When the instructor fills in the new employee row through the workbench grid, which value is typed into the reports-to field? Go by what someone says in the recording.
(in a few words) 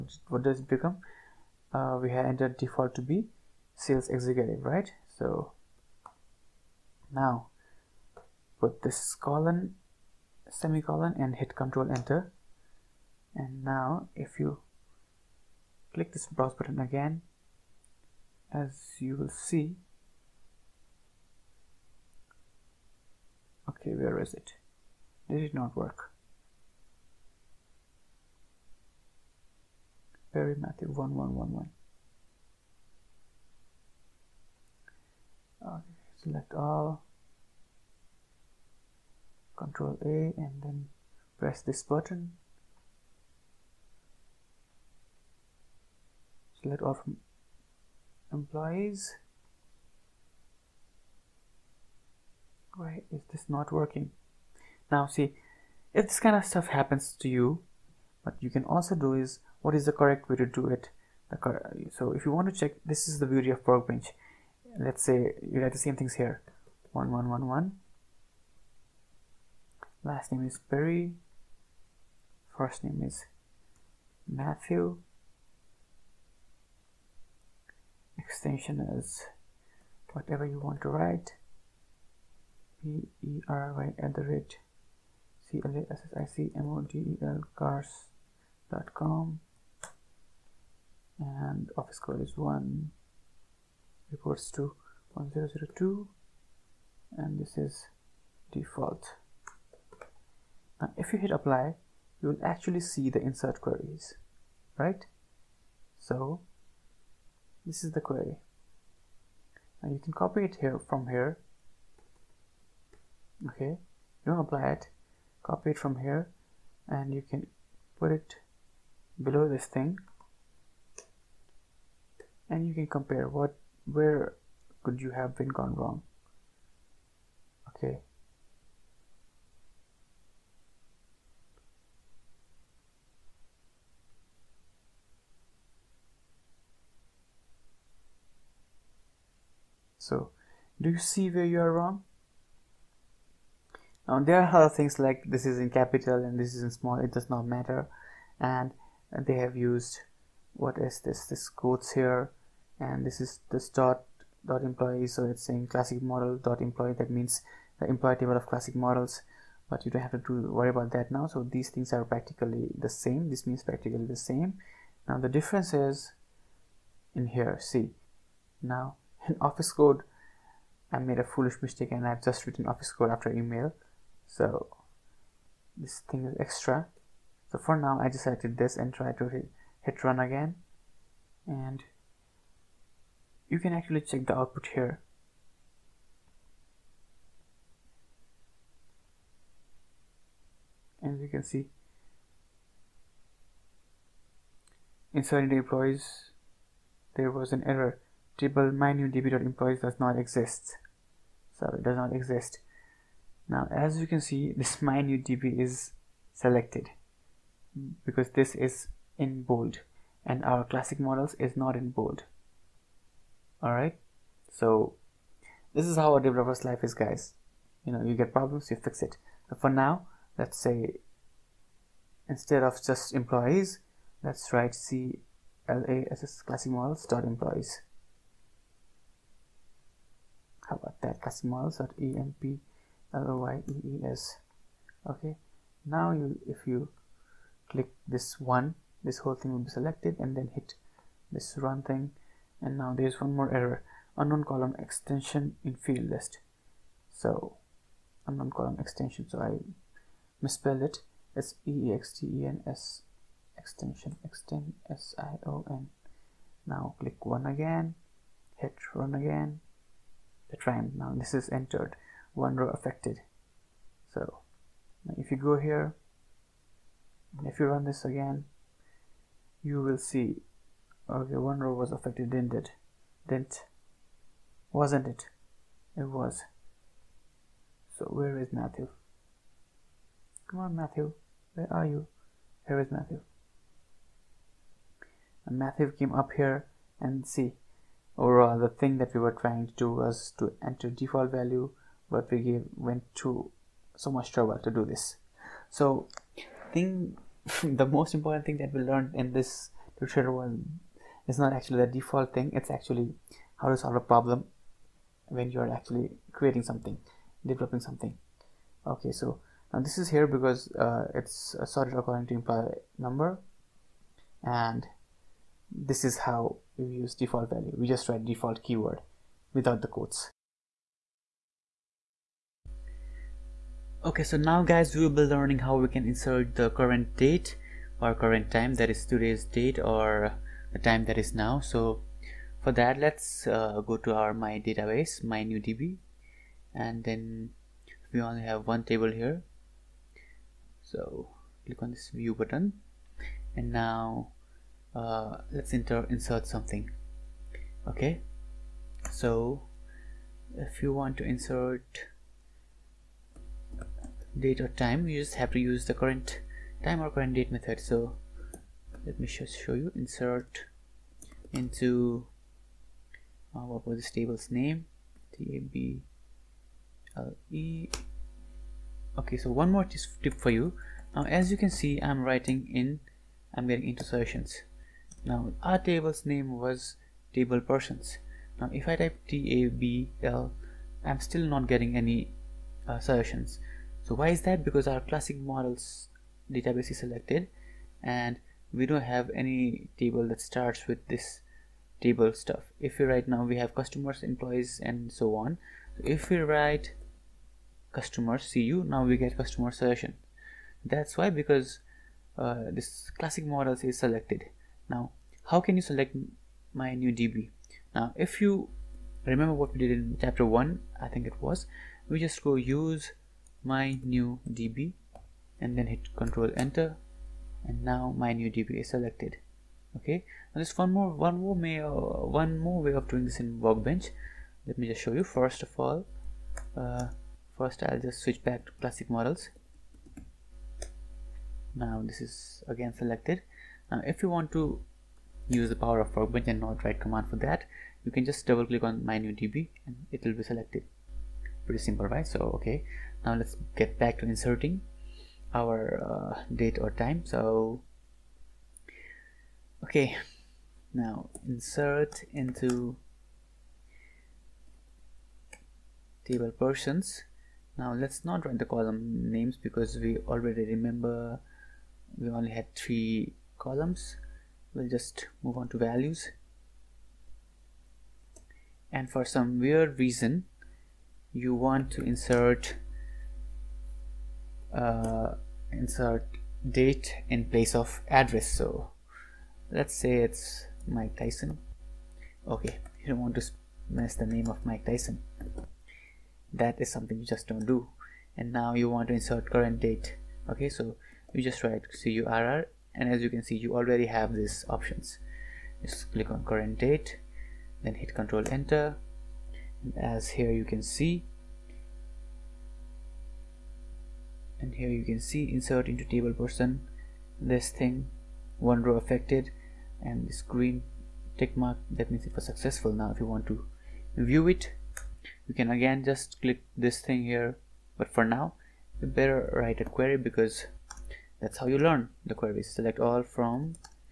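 1002.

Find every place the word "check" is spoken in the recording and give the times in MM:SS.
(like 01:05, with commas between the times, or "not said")
01:02, 03:03.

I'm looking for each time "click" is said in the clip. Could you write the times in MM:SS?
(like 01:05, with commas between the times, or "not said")
00:15, 03:57, 04:16, 05:41, 07:18, 08:16, 08:36.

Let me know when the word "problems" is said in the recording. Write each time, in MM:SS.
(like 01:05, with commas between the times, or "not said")
03:38, 05:03.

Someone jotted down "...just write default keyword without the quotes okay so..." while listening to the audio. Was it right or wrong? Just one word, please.
right.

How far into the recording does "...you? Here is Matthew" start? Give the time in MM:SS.
04:41.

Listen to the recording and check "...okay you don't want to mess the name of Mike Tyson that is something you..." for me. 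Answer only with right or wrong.
right.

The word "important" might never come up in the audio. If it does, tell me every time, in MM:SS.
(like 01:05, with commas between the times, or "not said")
04:58.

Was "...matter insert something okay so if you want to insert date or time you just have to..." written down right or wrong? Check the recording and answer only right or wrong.
wrong.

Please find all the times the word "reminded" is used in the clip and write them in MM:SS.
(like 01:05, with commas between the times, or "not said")
not said.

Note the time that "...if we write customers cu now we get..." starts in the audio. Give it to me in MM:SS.
06:36.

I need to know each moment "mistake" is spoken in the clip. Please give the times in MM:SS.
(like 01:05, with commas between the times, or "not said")
02:51.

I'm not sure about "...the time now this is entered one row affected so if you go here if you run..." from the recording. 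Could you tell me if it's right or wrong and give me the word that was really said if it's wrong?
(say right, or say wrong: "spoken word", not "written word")
right.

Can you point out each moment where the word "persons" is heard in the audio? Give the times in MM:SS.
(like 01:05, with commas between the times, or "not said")
06:17, 07:36, 08:26.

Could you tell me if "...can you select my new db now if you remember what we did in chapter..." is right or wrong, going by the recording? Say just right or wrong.
right.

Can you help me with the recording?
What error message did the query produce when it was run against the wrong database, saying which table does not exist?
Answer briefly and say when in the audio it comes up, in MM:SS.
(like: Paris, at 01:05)
mynewdb.employees, at 03:18.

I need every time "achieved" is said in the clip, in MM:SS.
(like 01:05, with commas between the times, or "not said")
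not said.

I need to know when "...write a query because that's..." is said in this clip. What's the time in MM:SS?
08:39.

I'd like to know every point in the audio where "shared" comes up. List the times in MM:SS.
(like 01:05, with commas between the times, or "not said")
not said.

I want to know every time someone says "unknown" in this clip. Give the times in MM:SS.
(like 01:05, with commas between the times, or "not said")
04:04, 04:08.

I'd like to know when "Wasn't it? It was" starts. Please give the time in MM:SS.
04:34.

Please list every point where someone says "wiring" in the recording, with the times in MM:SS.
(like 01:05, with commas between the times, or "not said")
not said.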